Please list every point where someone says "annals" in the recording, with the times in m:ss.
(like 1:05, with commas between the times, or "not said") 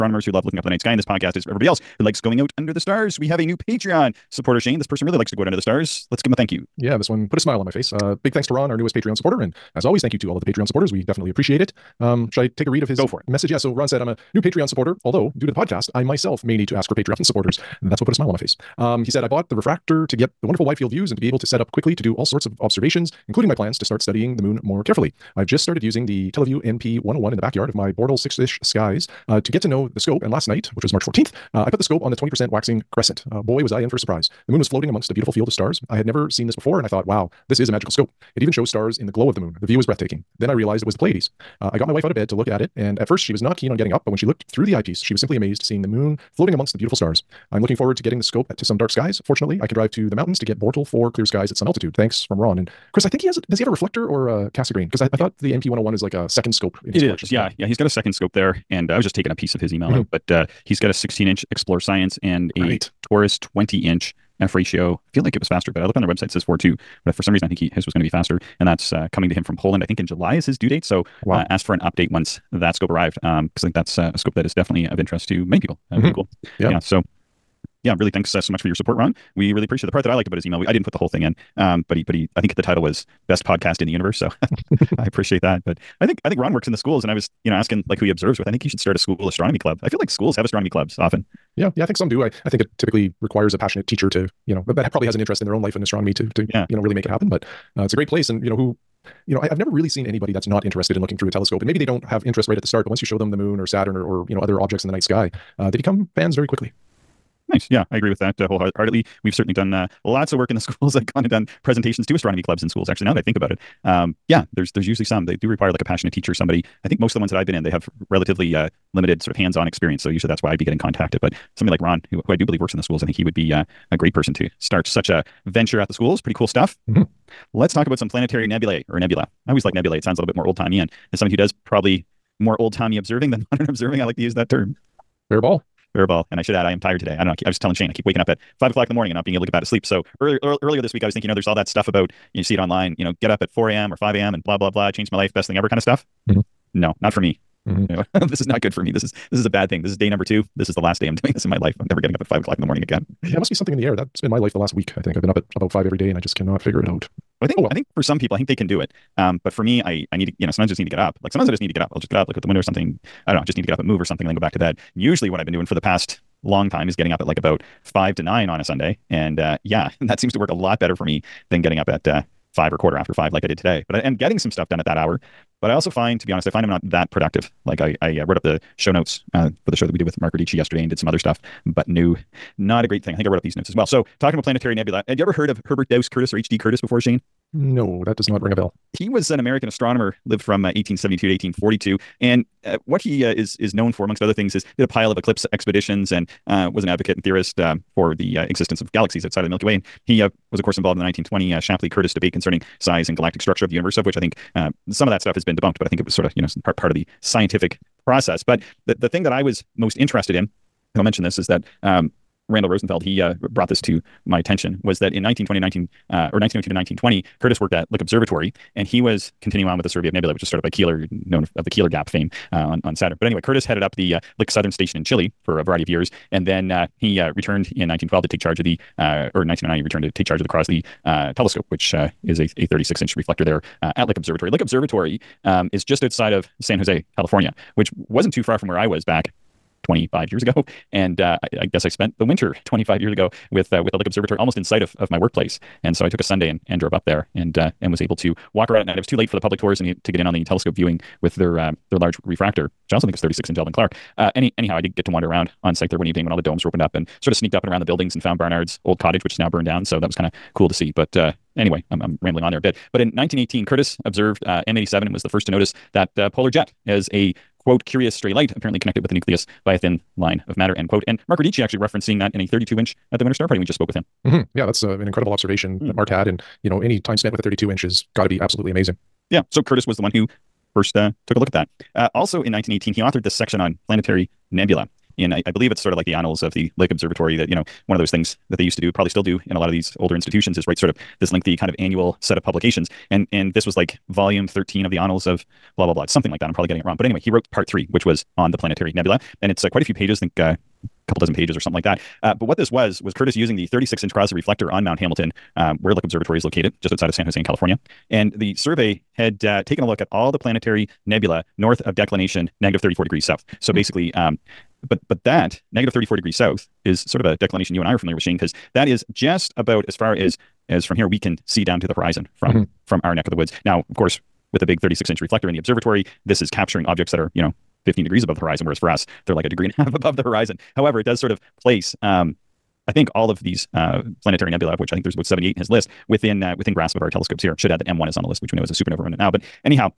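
4:46, 4:54.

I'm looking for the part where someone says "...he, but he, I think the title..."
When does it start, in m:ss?
1:21.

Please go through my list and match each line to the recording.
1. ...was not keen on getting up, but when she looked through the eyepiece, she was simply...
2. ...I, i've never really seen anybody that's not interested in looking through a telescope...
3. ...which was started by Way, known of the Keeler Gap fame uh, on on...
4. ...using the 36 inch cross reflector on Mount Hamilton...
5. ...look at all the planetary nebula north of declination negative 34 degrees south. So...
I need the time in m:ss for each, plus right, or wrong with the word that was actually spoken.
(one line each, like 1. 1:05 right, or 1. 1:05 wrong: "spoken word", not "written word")
1. 0:43 right
2. 1:39 right
3. 3:40 wrong: "Keeler", not "Way"
4. 5:03 right
5. 5:09 right.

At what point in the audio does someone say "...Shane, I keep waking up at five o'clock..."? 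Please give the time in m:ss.
2:17.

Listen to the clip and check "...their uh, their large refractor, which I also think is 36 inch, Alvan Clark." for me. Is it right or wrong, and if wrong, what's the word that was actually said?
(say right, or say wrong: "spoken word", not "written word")
right.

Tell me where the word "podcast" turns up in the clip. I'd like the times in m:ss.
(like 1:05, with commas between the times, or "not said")
0:01, 0:15, 1:23.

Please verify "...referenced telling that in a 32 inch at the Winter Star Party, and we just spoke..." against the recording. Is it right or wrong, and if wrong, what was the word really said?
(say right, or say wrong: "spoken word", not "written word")
wrong: "seeing", not "telling".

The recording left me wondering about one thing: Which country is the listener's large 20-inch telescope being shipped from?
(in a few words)
Poland.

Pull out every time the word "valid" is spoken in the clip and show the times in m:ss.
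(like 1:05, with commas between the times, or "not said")
not said.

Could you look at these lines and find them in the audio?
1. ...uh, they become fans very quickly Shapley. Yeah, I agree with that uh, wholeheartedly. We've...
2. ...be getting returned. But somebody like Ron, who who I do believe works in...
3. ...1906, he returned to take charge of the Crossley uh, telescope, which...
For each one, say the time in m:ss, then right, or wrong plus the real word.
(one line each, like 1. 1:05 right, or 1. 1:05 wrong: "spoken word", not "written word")
1. 1:45 wrong: "Nice", not "Shapley"
2. 2:00 wrong: "contacted", not "returned"
3. 3:49 wrong: "1909", not "1906".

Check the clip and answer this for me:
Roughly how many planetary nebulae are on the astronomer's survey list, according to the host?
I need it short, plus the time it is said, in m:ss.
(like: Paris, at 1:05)
78, at 5:35.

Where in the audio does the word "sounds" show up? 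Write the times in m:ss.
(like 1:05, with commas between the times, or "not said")
2:10.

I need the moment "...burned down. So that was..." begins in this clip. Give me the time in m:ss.
4:19.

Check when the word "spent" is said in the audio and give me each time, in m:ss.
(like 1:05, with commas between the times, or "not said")
4:01, 4:37.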